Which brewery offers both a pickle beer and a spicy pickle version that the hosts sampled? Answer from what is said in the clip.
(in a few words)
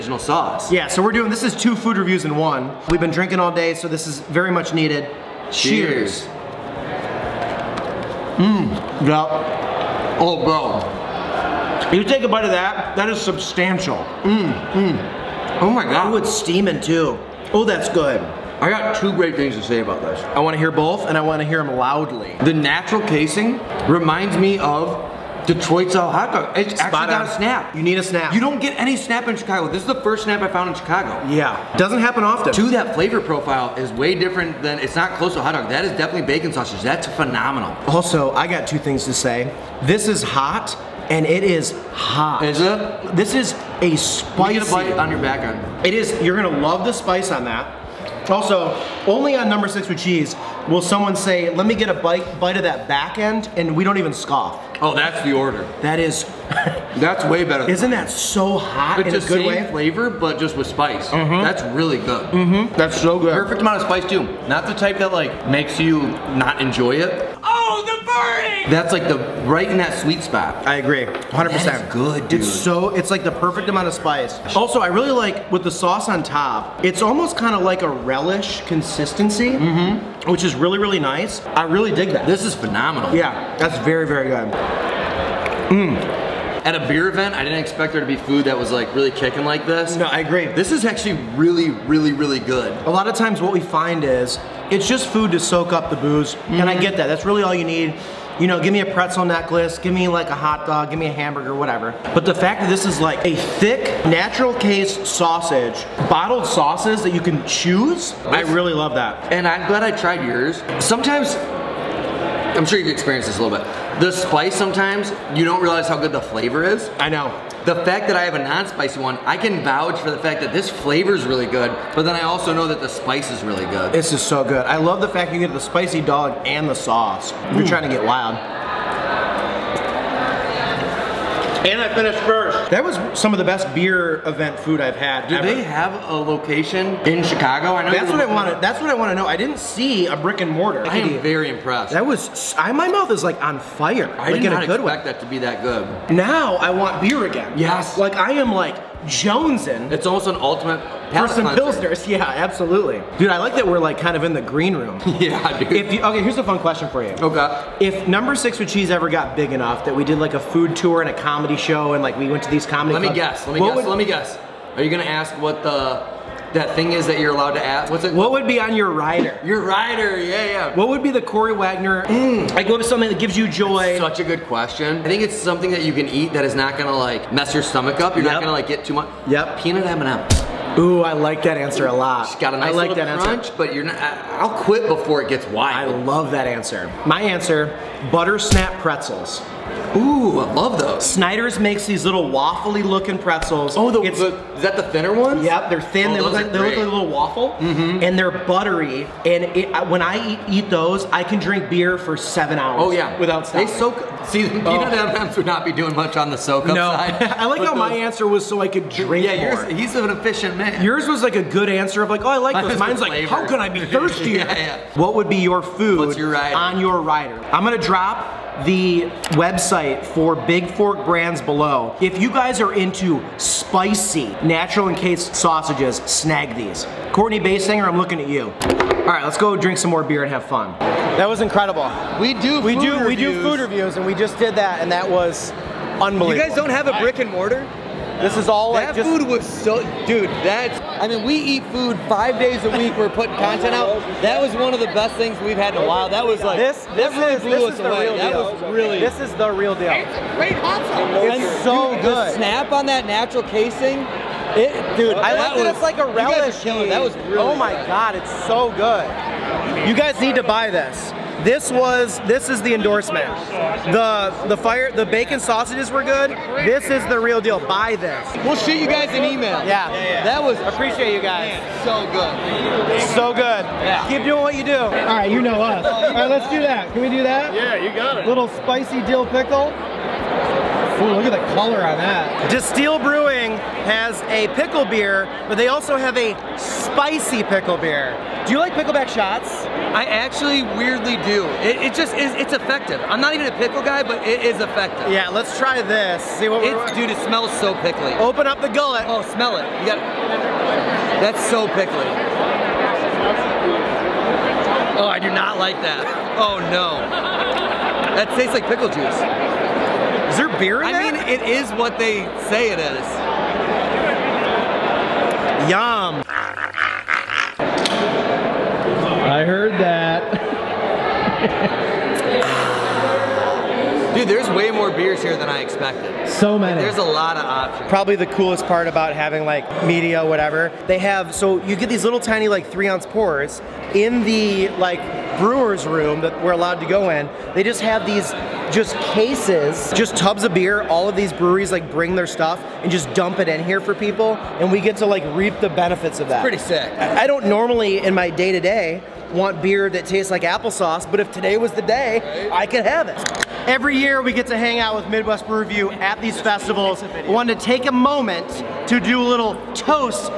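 Distill Brewing.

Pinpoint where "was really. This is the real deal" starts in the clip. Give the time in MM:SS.
04:08.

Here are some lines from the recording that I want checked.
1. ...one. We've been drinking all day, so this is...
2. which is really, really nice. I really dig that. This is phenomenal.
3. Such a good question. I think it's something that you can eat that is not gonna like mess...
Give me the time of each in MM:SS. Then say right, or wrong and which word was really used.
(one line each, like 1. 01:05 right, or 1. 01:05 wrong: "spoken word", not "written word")
1. 00:02 right
2. 01:20 right
3. 02:53 right.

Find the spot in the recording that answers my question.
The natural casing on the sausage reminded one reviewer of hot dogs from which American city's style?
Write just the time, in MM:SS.
00:25.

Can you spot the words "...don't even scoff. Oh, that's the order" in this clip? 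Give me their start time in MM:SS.
00:53.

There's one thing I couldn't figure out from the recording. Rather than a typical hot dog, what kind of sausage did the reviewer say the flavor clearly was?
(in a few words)
Bacon sausage.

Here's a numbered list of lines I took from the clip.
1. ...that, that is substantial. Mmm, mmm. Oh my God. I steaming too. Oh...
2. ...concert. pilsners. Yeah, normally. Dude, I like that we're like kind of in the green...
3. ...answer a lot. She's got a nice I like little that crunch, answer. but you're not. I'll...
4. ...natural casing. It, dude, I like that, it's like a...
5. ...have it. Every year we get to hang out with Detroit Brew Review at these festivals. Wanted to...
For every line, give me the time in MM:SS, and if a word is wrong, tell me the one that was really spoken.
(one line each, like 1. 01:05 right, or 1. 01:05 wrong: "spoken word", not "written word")
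1. 00:12 right
2. 02:31 wrong: "absolutely", not "normally"
3. 03:01 right
4. 04:13 right
5. 05:52 wrong: "Midwest", not "Detroit".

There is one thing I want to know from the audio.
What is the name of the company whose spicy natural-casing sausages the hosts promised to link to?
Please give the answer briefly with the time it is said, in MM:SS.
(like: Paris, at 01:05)
Big Fork Brands, at 03:40.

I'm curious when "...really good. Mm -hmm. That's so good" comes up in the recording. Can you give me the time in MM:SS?
01:01.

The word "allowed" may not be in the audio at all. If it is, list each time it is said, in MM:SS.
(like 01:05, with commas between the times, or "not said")
02:47, 05:36.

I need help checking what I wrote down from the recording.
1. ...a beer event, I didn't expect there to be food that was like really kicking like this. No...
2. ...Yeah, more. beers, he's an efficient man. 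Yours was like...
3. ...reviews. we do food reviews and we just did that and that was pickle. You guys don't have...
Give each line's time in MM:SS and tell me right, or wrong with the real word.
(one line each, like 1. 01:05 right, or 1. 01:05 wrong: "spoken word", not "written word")
1. 01:26 right
2. 03:29 wrong: "yours", not "beers"
3. 03:52 wrong: "unbelievable", not "pickle".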